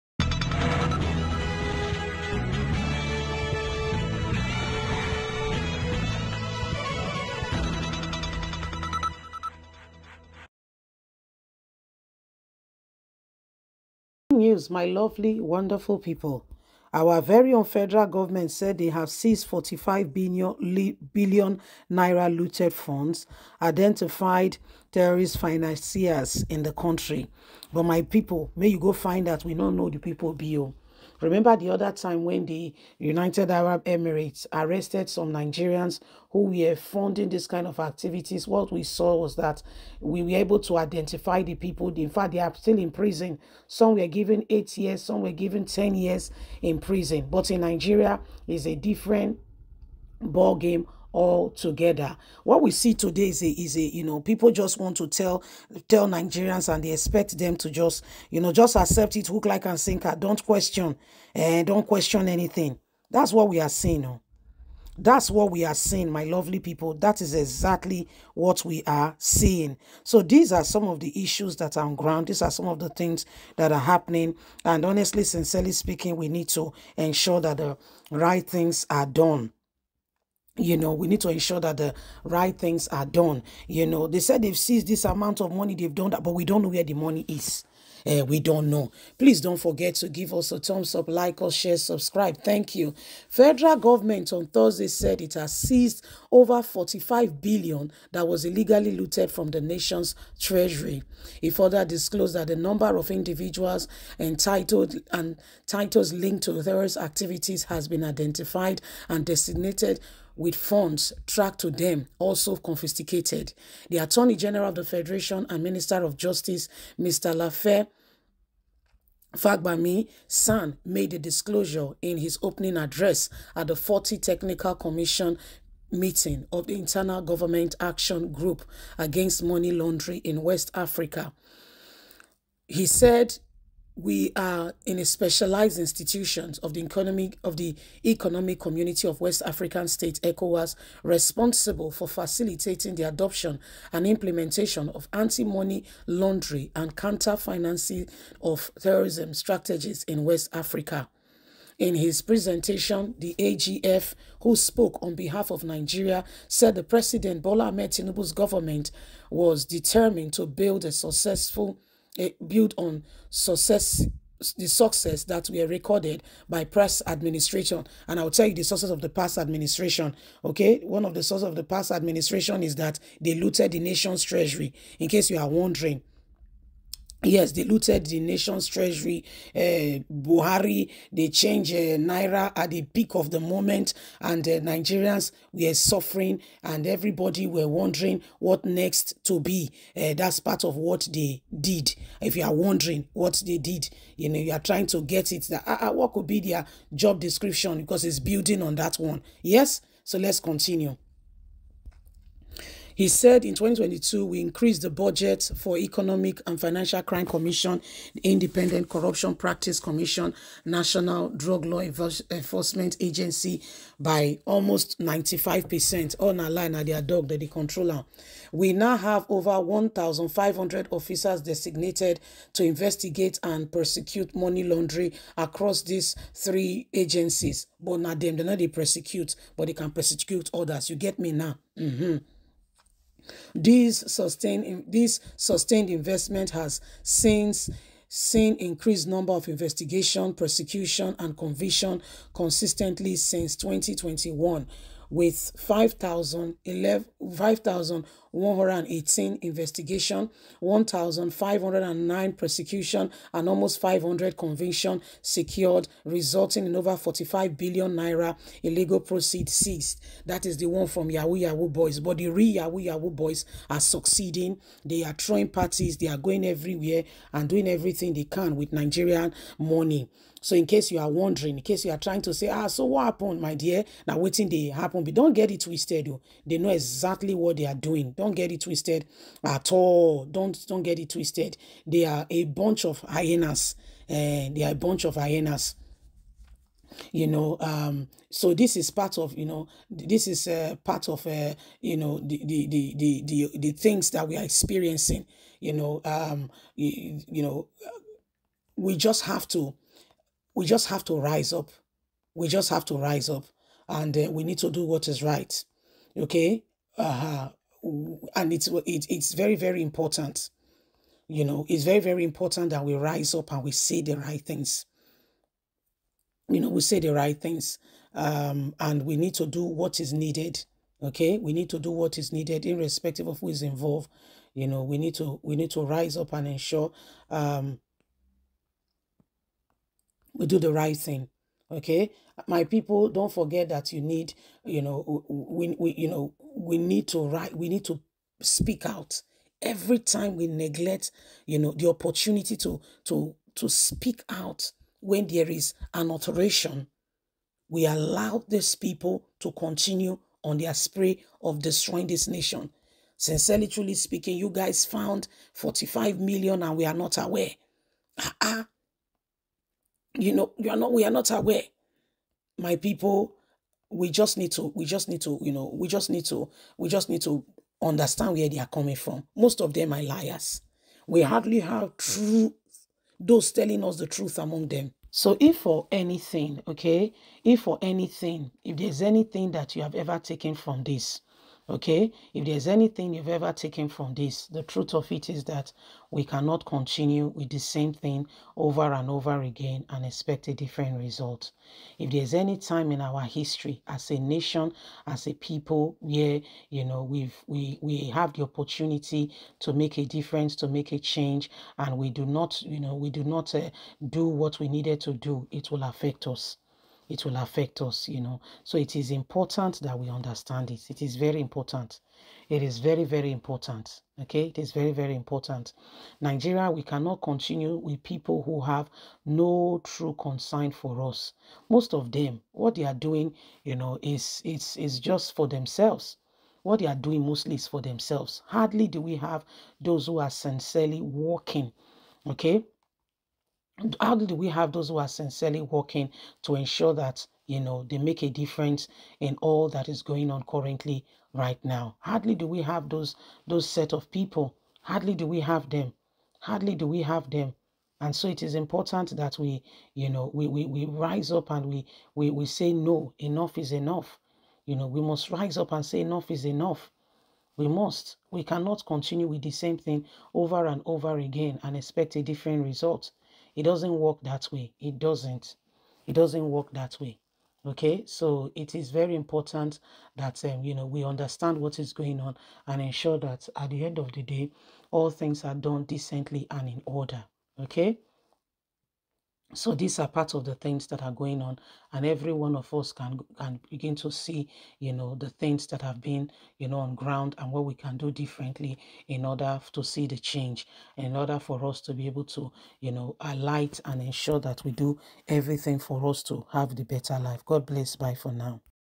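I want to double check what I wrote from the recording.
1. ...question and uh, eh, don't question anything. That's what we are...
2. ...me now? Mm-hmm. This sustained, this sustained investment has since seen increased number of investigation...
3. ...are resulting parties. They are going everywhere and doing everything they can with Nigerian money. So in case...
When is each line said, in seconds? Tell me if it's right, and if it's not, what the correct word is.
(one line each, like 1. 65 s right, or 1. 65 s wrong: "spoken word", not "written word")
1. 60 s right
2. 231 s right
3. 265 s wrong: "throwing", not "resulting".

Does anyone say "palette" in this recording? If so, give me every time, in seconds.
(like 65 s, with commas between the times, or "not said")
not said.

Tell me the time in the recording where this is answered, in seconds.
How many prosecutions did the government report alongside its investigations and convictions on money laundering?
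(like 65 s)
250 s.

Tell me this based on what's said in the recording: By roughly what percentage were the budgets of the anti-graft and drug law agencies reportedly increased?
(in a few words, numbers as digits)
95%.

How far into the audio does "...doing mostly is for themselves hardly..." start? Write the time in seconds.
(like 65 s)
427 s.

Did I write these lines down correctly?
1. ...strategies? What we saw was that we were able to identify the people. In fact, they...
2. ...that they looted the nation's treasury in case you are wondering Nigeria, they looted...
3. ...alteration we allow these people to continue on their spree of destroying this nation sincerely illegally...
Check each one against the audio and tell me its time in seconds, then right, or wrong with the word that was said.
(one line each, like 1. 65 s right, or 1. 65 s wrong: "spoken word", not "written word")
1. 37 s wrong: "activities", not "strategies"
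2. 172 s wrong: "Yes", not "Nigeria"
3. 346 s wrong: "truly", not "illegally".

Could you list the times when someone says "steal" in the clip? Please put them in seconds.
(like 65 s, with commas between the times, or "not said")
not said.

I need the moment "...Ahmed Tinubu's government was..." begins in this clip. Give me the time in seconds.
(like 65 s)
157 s.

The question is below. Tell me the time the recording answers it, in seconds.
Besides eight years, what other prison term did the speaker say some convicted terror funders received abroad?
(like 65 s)
45 s.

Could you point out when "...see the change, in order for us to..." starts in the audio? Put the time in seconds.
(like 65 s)
489 s.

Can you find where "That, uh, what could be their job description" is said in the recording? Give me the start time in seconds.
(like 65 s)
195 s.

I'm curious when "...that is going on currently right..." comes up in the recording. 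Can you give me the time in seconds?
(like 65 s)
439 s.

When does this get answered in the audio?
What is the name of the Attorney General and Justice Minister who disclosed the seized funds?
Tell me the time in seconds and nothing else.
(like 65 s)
117 s.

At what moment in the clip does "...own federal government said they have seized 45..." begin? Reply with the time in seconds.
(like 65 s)
17 s.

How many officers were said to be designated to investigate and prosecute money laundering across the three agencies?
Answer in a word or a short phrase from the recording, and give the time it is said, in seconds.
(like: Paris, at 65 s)
1,500, at 219 s.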